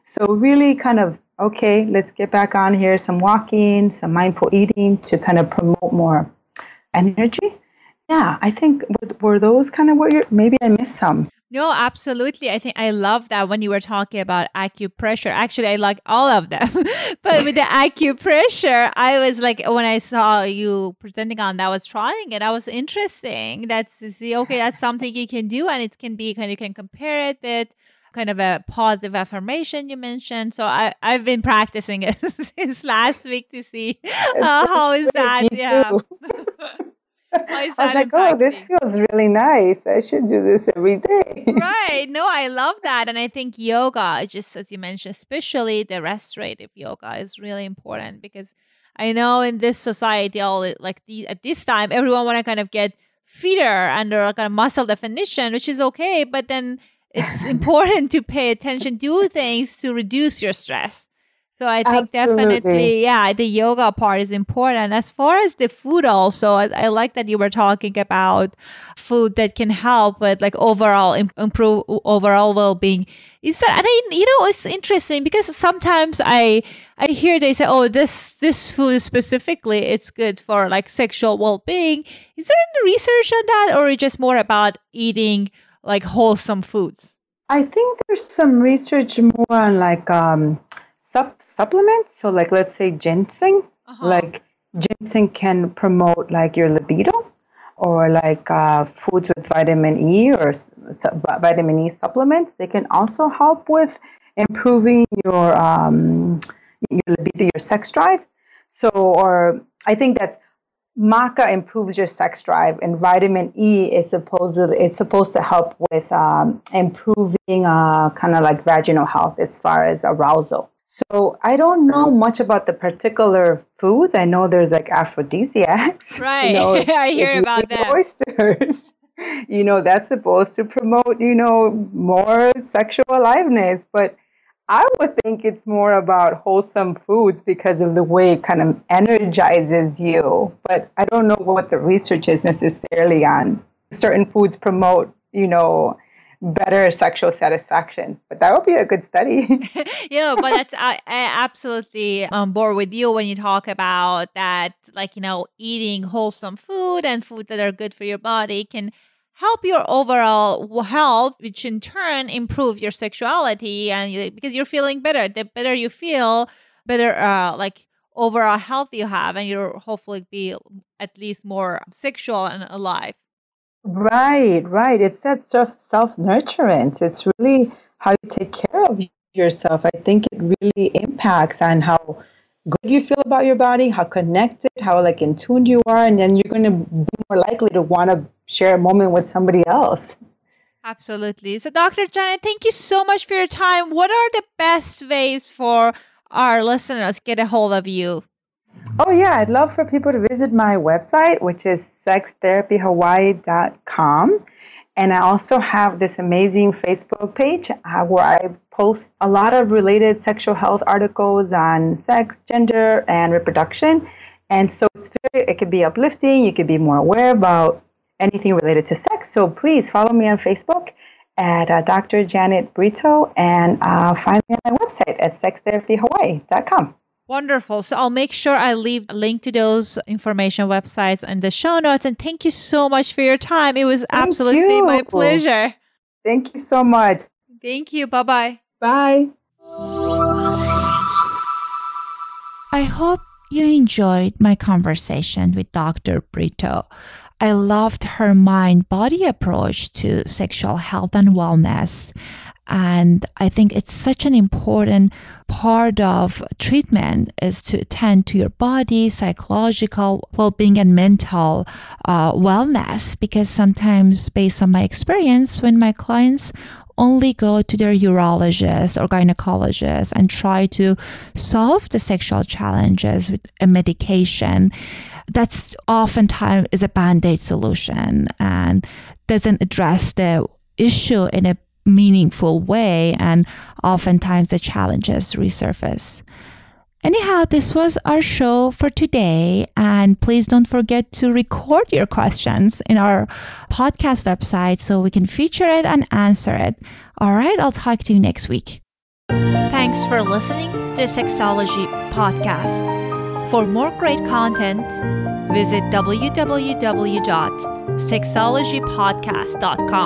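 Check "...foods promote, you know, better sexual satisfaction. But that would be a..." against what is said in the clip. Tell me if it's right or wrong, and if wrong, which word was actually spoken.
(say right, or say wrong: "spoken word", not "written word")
right.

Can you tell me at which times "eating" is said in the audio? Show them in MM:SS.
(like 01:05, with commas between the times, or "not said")
00:04, 01:24, 02:35.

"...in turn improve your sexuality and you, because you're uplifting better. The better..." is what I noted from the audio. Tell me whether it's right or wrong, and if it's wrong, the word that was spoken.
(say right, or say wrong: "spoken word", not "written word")
wrong: "feeling", not "uplifting".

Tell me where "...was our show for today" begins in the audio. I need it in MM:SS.
04:47.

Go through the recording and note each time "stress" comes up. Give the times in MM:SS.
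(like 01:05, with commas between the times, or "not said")
01:00.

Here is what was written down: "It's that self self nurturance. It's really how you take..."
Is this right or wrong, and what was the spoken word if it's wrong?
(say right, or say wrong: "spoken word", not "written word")
right.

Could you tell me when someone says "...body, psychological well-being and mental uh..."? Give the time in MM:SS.
04:18.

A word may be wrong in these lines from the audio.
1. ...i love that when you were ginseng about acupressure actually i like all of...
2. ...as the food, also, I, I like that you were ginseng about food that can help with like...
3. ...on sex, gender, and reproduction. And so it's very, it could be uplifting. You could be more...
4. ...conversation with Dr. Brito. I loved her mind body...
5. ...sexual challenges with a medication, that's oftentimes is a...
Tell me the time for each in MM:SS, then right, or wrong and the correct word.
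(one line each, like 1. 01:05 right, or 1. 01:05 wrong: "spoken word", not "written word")
1. 00:12 wrong: "talking", not "ginseng"
2. 01:05 wrong: "talking", not "ginseng"
3. 03:31 right
4. 04:04 right
5. 04:31 right.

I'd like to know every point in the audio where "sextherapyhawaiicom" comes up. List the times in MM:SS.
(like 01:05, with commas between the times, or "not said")
03:22, 03:45.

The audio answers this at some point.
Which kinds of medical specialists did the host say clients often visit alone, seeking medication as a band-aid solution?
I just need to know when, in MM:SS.
04:27.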